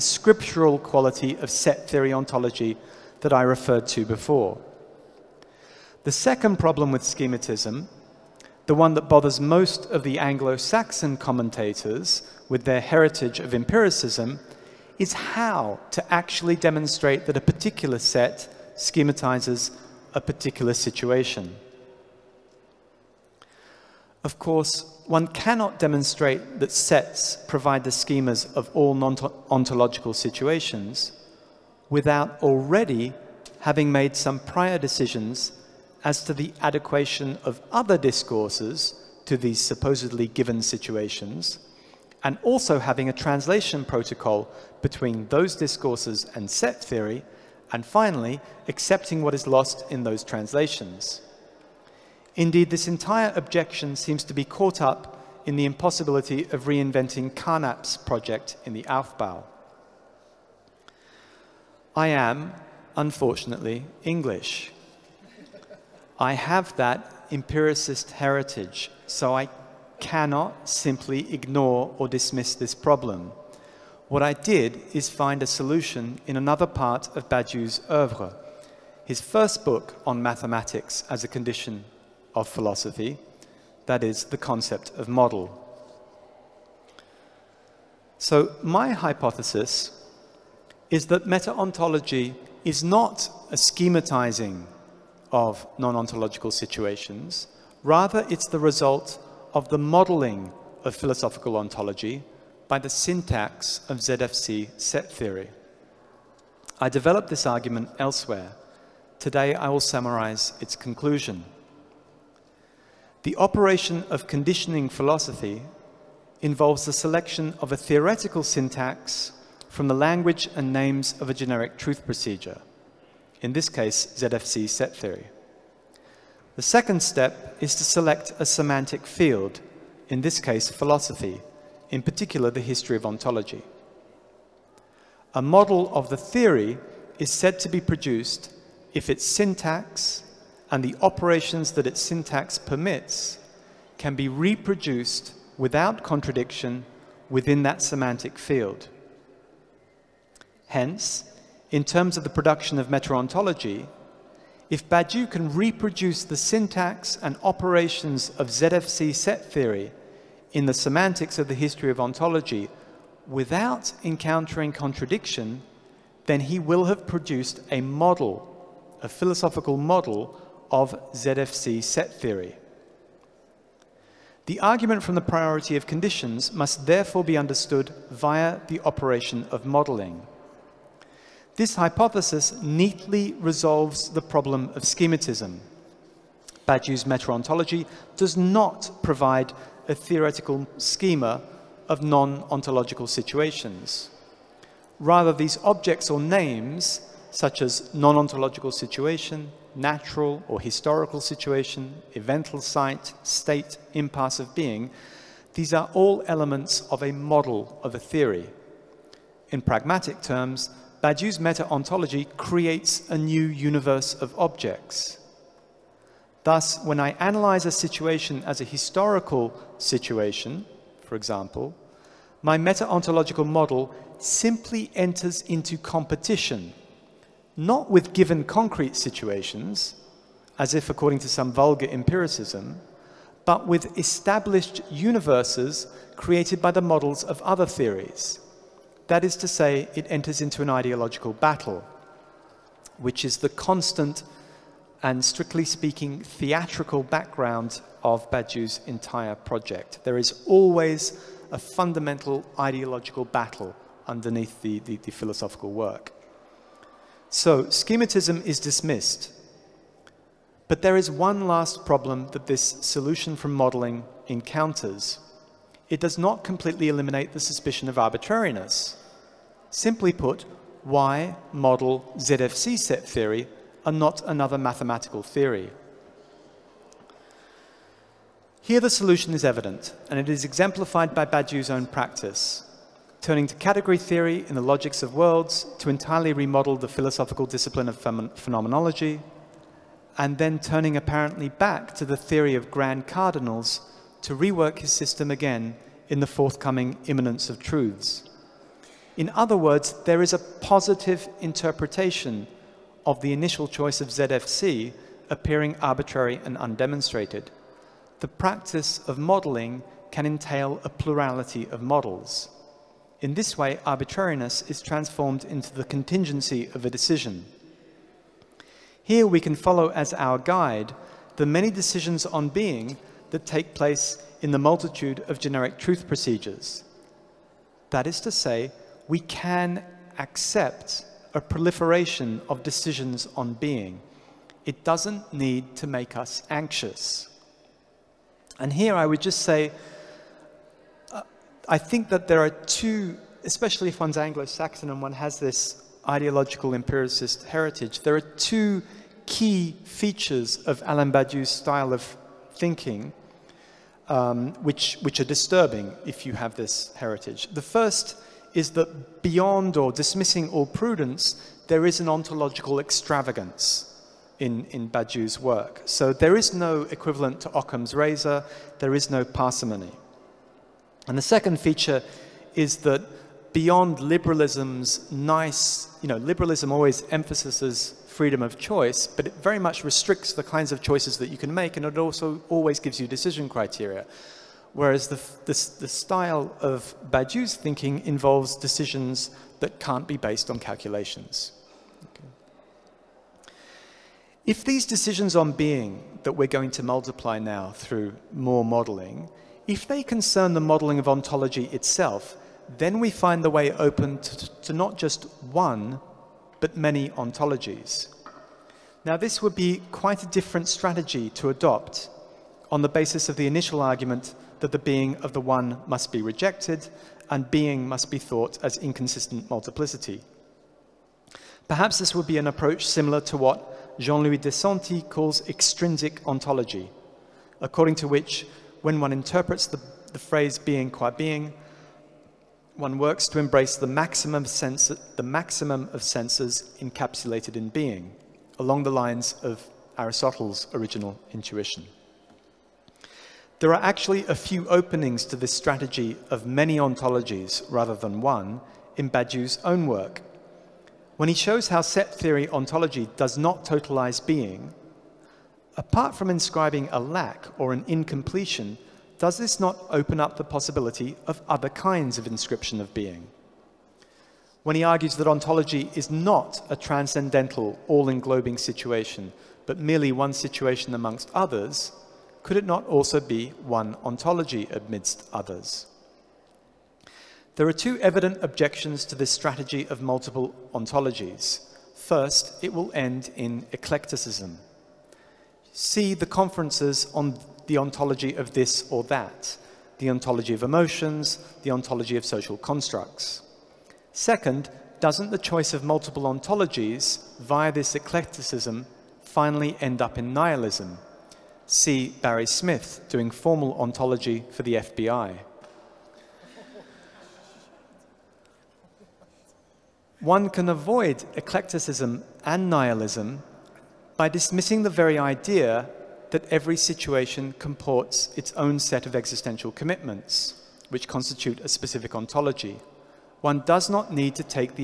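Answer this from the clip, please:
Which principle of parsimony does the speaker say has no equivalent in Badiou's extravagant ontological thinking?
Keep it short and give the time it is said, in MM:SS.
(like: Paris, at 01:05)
Occam's razor, at 06:07.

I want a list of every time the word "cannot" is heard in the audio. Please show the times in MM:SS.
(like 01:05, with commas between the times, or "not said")
00:25, 01:10.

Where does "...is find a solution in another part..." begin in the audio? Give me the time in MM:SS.
01:14.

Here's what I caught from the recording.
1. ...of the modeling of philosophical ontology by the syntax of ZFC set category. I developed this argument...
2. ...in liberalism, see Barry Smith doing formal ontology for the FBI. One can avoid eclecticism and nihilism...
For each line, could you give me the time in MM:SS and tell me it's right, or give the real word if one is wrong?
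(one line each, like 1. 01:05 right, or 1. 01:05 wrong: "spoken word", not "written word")
1. 01:39 wrong: "theory", not "category"
2. 08:20 wrong: "nihilism", not "liberalism".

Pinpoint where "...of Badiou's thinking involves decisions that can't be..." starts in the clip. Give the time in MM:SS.
06:26.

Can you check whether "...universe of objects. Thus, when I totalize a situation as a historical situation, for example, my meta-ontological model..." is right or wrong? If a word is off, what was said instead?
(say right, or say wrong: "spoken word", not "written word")
wrong: "analyze", not "totalize".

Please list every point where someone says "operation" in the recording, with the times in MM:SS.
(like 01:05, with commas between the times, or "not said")
01:53, 02:21, 02:37, 02:58.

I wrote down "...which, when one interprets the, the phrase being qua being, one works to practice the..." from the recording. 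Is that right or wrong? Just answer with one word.
wrong.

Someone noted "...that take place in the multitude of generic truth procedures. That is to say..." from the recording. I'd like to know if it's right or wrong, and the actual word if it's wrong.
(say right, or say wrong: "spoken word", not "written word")
right.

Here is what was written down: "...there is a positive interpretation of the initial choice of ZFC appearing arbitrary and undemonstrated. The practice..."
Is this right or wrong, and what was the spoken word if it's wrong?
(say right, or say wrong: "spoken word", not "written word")
right.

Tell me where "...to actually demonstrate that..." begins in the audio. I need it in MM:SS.
00:15.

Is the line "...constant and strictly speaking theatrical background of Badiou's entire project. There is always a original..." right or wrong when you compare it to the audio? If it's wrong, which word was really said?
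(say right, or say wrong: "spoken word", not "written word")
wrong: "fundamental", not "original".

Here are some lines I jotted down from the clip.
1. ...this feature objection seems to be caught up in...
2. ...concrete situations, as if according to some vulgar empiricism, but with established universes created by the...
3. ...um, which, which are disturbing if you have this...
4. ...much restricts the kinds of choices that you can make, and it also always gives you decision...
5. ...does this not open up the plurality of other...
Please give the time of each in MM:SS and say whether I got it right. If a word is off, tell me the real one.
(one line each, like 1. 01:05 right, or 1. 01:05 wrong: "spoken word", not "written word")
1. 00:52 wrong: "entire", not "feature"
2. 03:48 right
3. 05:54 right
4. 06:19 right
5. 07:39 wrong: "possibility", not "plurality".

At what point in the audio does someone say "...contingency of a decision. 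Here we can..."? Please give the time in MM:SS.
05:15.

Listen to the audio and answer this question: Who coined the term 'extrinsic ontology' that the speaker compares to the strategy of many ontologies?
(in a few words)
Jean-Louis Desanti.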